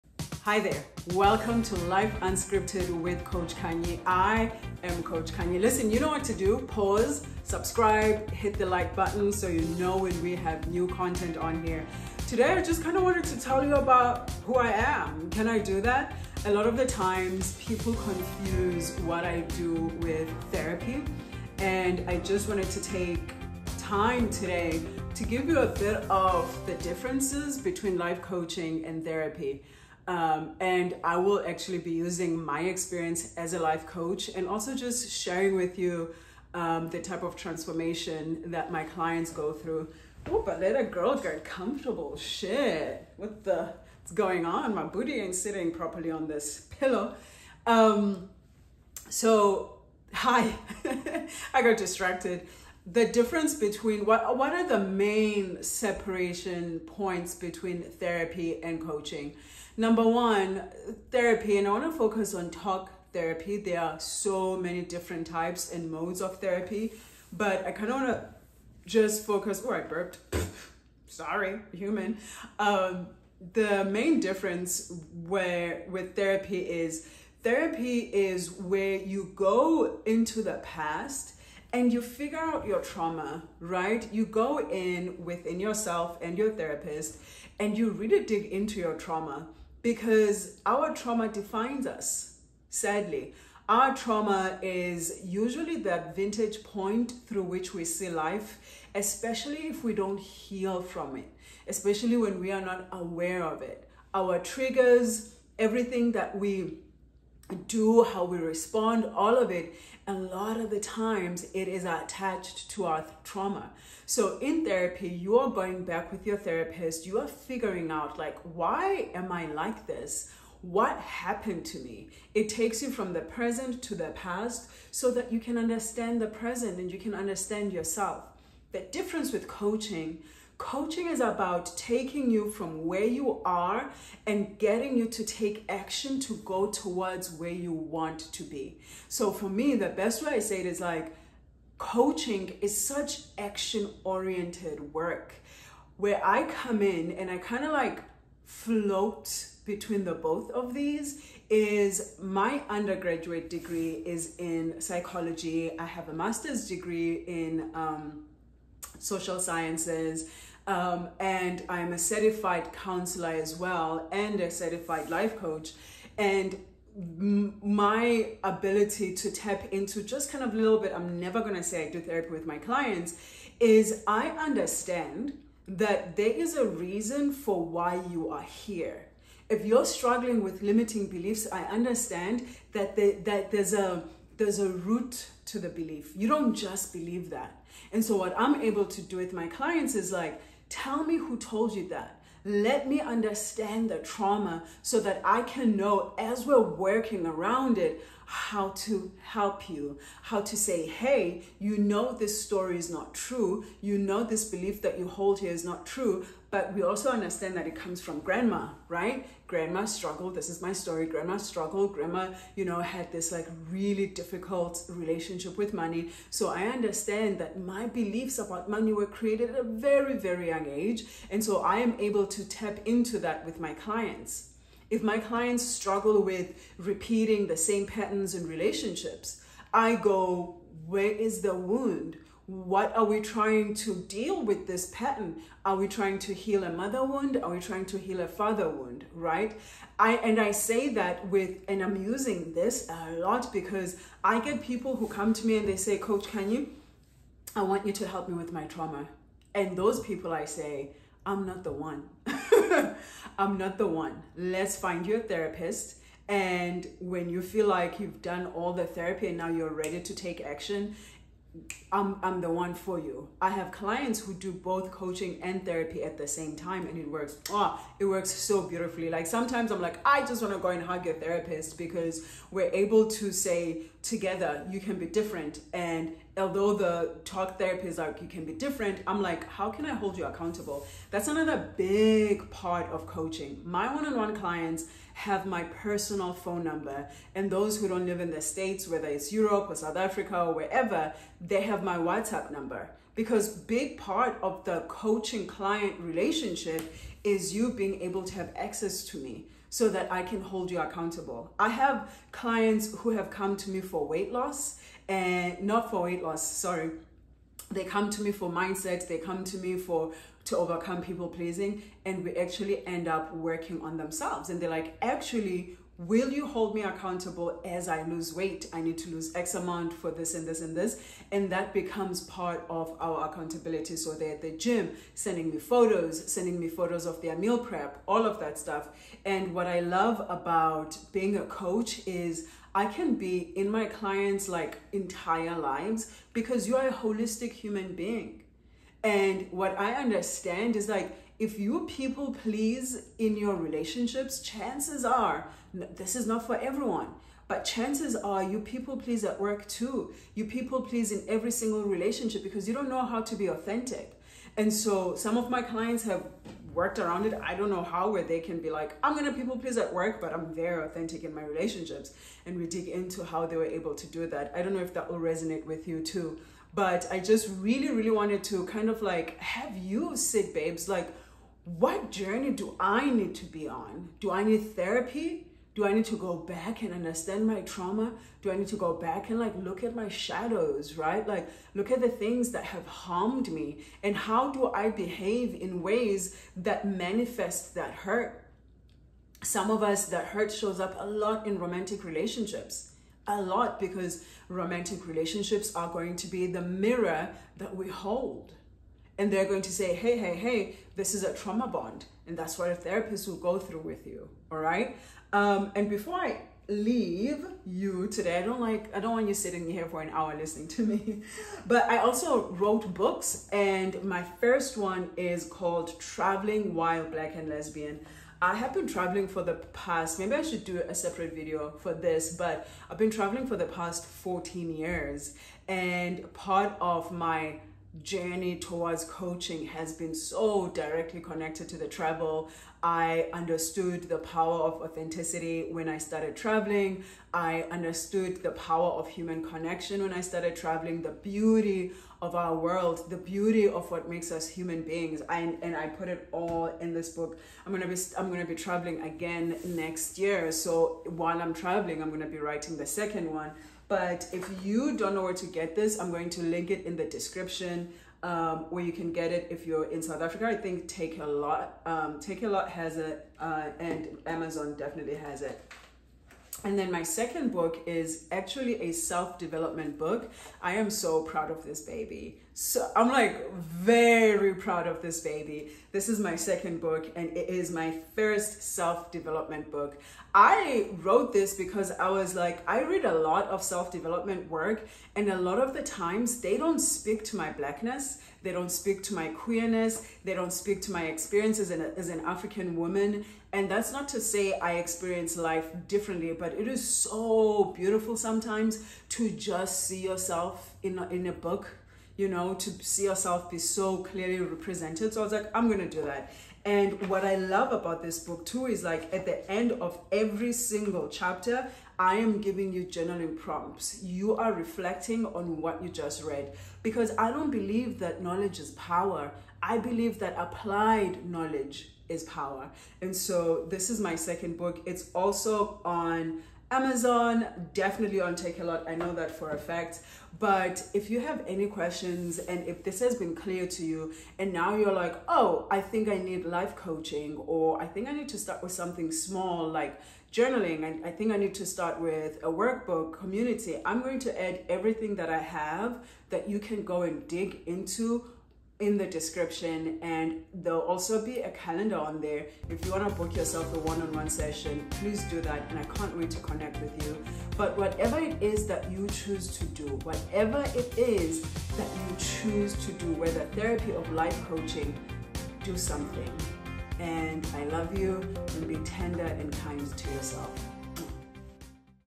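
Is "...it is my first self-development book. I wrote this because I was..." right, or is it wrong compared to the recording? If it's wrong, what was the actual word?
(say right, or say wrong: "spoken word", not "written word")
right.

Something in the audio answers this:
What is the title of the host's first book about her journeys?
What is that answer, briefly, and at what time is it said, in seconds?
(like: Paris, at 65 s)
Traveling While Black and Lesbian, at 415 s.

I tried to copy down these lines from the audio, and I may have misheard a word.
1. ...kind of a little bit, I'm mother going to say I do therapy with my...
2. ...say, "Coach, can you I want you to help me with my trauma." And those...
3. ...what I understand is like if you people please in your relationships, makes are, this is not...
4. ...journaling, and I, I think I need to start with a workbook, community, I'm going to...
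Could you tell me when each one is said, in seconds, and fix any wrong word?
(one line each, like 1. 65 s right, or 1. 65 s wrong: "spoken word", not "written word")
1. 170 s wrong: "never", not "mother"
2. 245 s right
3. 339 s wrong: "chances", not "makes"
4. 540 s right.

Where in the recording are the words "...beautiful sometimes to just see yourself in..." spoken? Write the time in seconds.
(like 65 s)
497 s.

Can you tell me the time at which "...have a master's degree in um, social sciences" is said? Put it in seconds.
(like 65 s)
155 s.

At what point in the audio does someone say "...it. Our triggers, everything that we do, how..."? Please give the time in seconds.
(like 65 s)
103 s.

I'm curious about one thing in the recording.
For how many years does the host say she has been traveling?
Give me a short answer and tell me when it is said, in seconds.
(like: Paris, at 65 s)
14, at 424 s.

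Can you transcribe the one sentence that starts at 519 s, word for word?
I believe that applied knowledge is power.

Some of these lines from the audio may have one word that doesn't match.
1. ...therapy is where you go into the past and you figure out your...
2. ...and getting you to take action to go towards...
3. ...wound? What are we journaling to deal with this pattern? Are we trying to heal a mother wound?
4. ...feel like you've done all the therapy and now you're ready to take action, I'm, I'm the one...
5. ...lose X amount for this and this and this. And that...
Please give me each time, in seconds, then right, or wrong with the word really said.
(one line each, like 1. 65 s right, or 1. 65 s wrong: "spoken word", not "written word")
1. 77 s right
2. 134 s right
3. 231 s wrong: "trying", not "journaling"
4. 257 s right
5. 319 s right.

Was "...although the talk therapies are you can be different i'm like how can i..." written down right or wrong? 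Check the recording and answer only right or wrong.
right.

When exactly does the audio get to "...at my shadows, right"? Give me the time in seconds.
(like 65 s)
379 s.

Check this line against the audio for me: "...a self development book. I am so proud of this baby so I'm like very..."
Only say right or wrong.
right.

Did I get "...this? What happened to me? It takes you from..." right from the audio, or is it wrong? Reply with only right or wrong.
right.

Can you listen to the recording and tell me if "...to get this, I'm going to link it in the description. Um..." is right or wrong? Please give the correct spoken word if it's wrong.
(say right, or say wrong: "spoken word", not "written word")
right.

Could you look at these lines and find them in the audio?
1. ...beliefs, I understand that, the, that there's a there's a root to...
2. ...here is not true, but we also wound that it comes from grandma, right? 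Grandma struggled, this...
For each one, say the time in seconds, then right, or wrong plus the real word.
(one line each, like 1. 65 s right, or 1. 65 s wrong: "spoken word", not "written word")
1. 181 s right
2. 205 s wrong: "understand", not "wound".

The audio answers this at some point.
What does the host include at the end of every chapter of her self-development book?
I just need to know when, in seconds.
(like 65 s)
512 s.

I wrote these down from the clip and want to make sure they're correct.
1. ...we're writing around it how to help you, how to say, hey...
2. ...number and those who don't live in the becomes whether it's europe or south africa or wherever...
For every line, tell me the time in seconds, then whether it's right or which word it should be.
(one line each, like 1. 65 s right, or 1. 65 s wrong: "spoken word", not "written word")
1. 196 s wrong: "working", not "writing"
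2. 286 s wrong: "states", not "becomes".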